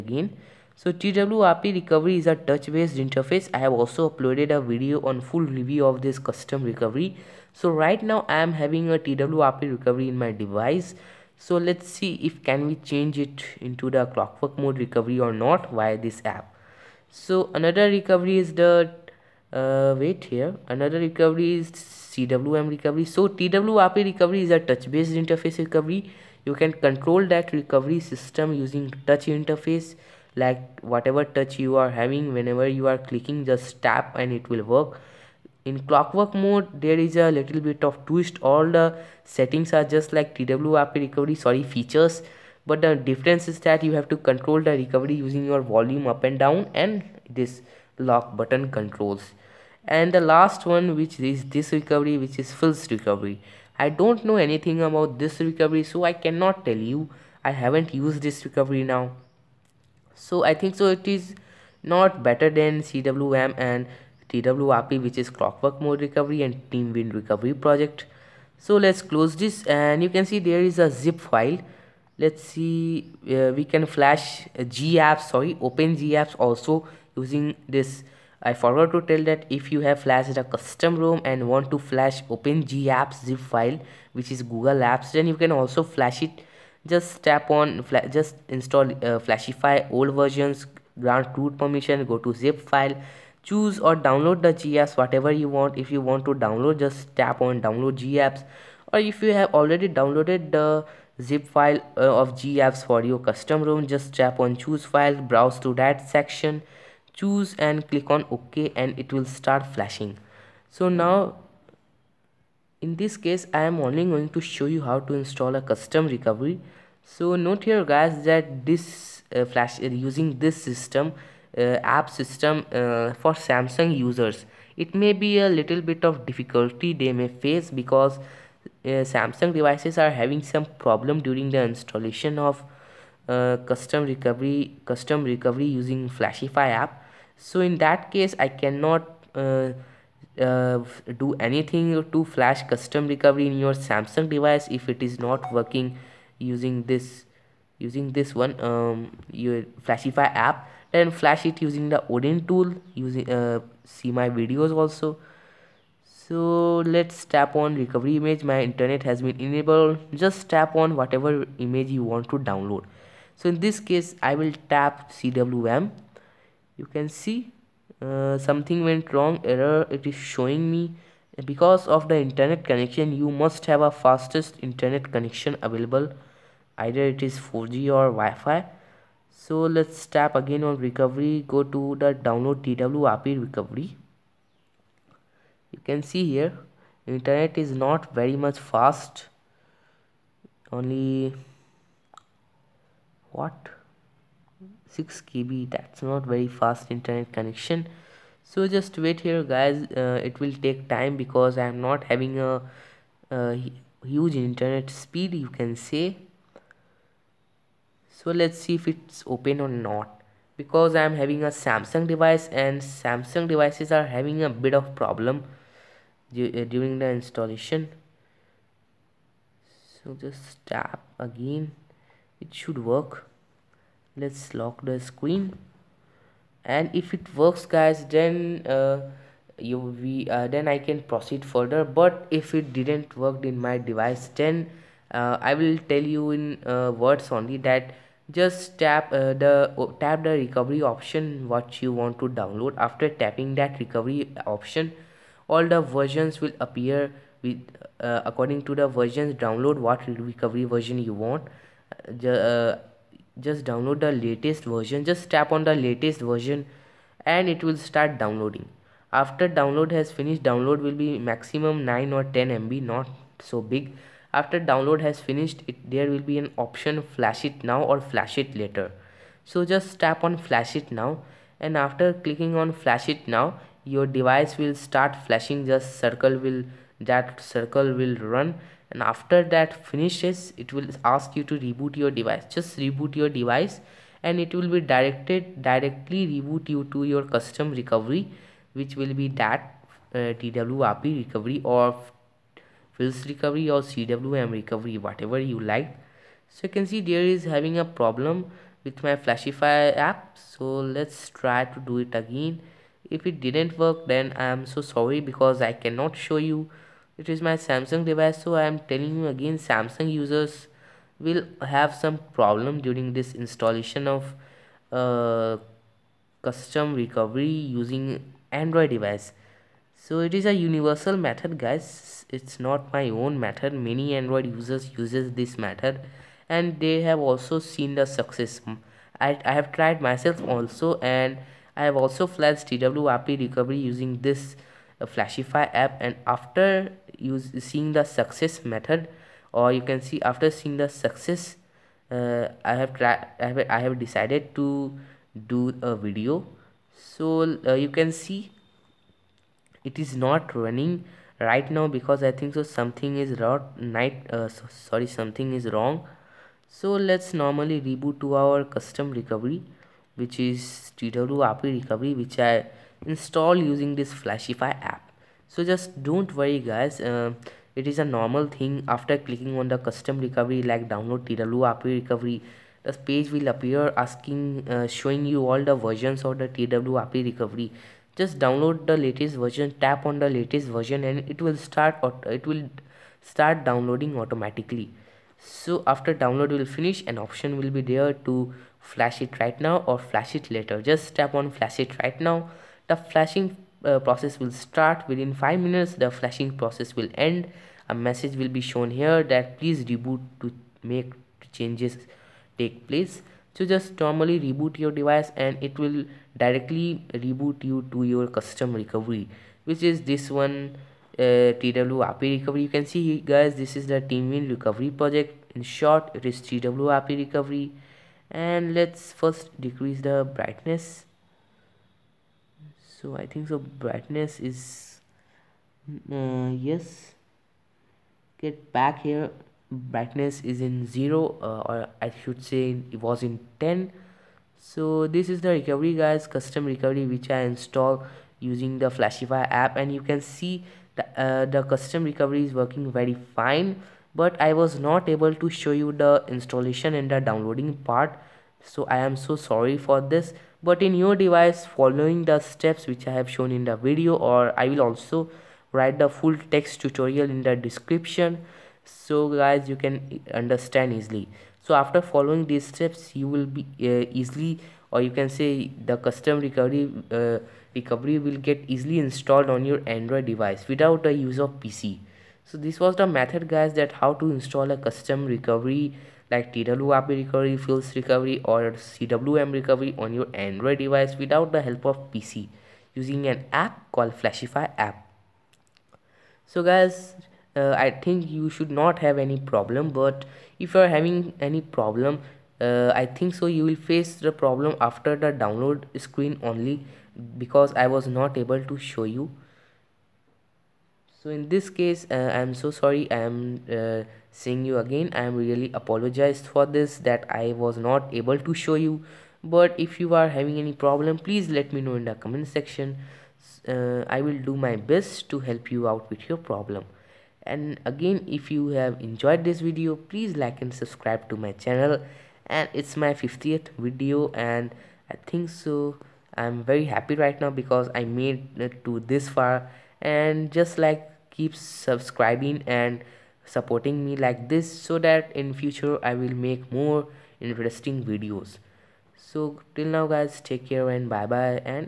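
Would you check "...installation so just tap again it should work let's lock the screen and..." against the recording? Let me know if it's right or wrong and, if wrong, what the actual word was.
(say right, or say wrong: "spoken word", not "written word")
right.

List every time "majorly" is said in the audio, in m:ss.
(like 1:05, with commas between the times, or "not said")
not said.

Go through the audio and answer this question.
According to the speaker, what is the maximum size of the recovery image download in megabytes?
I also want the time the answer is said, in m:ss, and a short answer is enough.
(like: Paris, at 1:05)
10 MB, at 4:22.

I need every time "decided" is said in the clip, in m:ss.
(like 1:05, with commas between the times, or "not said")
5:43.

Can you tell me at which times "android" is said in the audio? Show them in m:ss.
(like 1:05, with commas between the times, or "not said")
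5:18, 5:24, 7:49, 8:00.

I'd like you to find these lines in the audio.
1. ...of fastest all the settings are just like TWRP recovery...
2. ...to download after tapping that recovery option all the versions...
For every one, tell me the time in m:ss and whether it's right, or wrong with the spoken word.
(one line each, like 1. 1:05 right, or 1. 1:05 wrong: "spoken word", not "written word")
1. 0:37 wrong: "twist", not "fastest"
2. 4:02 right.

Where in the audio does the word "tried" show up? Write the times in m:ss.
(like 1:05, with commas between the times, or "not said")
5:29, 5:42.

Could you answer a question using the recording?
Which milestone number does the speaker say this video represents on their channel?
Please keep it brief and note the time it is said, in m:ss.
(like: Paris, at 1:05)
50th, at 8:43.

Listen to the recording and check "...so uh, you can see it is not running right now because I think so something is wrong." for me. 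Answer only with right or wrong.
right.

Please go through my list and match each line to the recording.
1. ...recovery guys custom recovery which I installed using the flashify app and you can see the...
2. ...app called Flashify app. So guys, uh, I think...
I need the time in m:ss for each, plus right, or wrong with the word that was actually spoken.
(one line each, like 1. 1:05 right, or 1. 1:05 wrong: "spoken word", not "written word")
1. 7:15 right
2. 8:03 right.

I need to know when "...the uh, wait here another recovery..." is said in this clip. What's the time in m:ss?
0:18.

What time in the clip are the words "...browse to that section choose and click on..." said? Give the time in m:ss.
1:45.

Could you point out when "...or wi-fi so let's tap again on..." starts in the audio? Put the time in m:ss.
2:57.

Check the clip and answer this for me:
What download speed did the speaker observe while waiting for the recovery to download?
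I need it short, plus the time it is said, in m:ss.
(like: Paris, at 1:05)
6 KB, at 3:14.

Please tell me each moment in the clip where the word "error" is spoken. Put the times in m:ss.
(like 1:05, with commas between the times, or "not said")
2:49.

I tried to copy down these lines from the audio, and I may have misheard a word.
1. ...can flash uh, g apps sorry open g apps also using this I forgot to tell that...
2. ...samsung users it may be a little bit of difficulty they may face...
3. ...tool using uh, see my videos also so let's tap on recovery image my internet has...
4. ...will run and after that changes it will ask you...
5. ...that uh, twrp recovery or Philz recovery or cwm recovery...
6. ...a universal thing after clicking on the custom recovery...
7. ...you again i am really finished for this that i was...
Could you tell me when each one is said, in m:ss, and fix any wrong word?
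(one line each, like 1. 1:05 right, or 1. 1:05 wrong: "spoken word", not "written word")
1. 1:13 right
2. 2:03 right
3. 2:32 right
4. 4:37 wrong: "finishes", not "changes"
5. 4:49 right
6. 6:07 wrong: "normal", not "universal"
7. 8:24 wrong: "apologized", not "finished".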